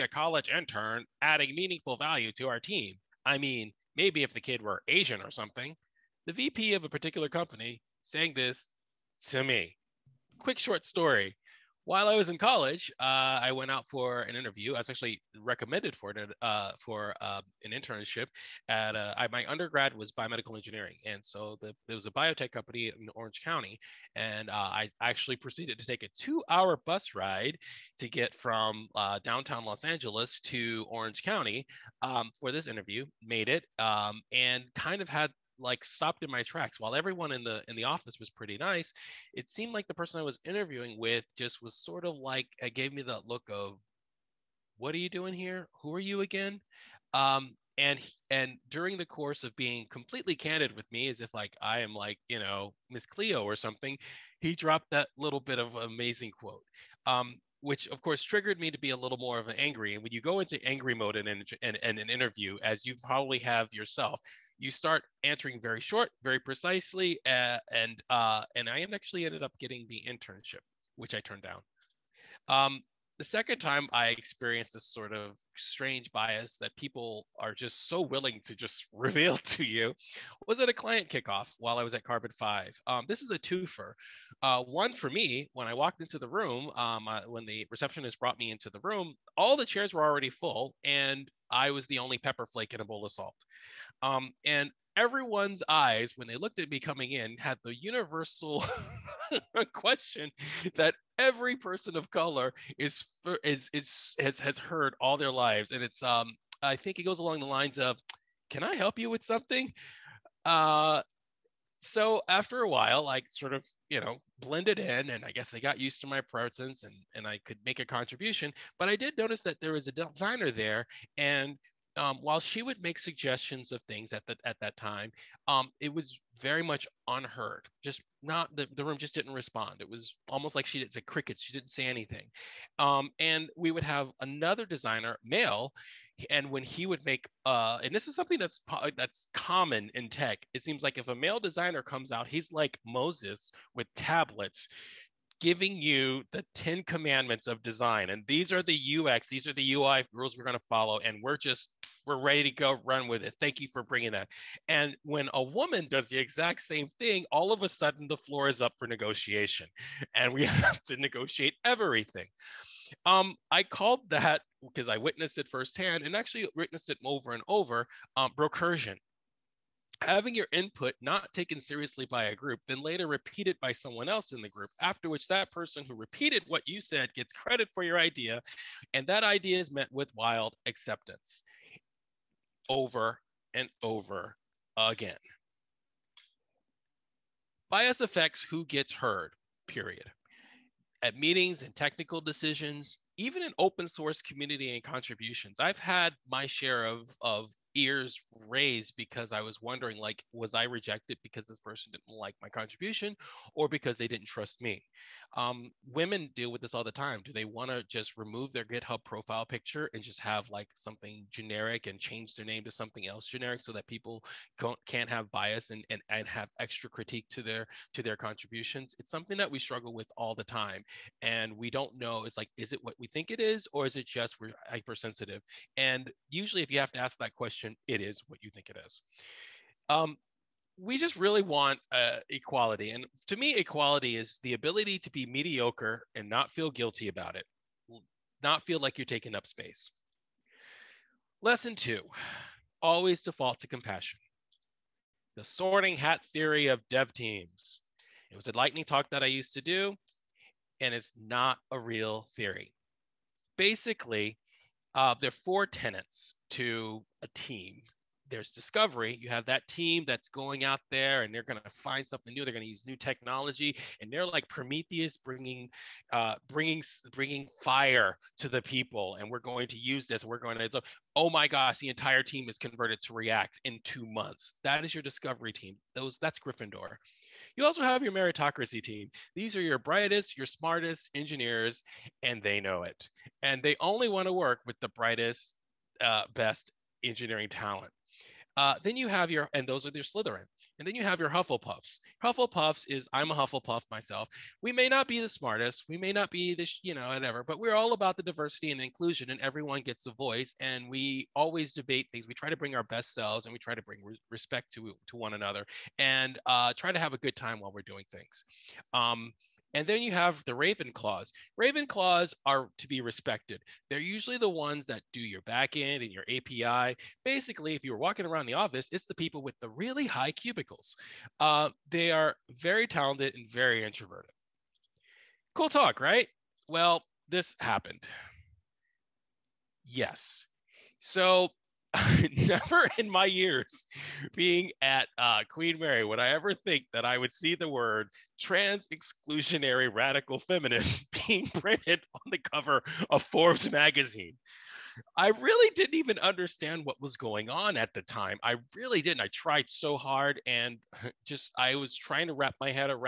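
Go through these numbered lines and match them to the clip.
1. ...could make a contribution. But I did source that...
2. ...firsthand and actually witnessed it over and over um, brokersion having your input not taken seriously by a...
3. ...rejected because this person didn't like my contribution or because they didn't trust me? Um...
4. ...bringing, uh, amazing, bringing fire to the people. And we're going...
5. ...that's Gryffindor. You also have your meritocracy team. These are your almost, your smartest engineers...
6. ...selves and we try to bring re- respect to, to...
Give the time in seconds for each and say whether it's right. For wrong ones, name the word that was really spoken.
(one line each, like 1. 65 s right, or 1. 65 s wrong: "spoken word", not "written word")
1. 117 s wrong: "notice", not "source"
2. 165 s right
3. 200 s right
4. 265 s wrong: "bringing", not "amazing"
5. 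276 s wrong: "brightest", not "almost"
6. 303 s right.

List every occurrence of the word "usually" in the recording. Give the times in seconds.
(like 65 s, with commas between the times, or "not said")
226 s, 313 s.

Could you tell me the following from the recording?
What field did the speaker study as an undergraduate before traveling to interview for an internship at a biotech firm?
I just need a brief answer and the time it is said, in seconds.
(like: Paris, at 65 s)
Biomedical engineering, at 20 s.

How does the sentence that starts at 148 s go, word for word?
And these are the UX, these are the UI rules we're going to follow.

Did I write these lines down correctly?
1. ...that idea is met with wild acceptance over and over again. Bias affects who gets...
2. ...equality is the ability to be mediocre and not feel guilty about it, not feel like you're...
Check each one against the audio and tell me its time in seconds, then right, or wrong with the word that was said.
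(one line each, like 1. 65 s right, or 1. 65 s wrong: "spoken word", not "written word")
1. 179 s right
2. 233 s right.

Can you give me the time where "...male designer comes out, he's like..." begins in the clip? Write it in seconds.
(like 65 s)
141 s.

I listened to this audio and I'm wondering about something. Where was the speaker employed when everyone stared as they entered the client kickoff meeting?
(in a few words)
Carbon 5.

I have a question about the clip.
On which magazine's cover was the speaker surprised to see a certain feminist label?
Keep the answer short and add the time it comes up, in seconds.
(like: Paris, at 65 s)
Forbes, at 343 s.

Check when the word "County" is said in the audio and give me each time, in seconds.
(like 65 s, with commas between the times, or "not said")
23 s, 31 s.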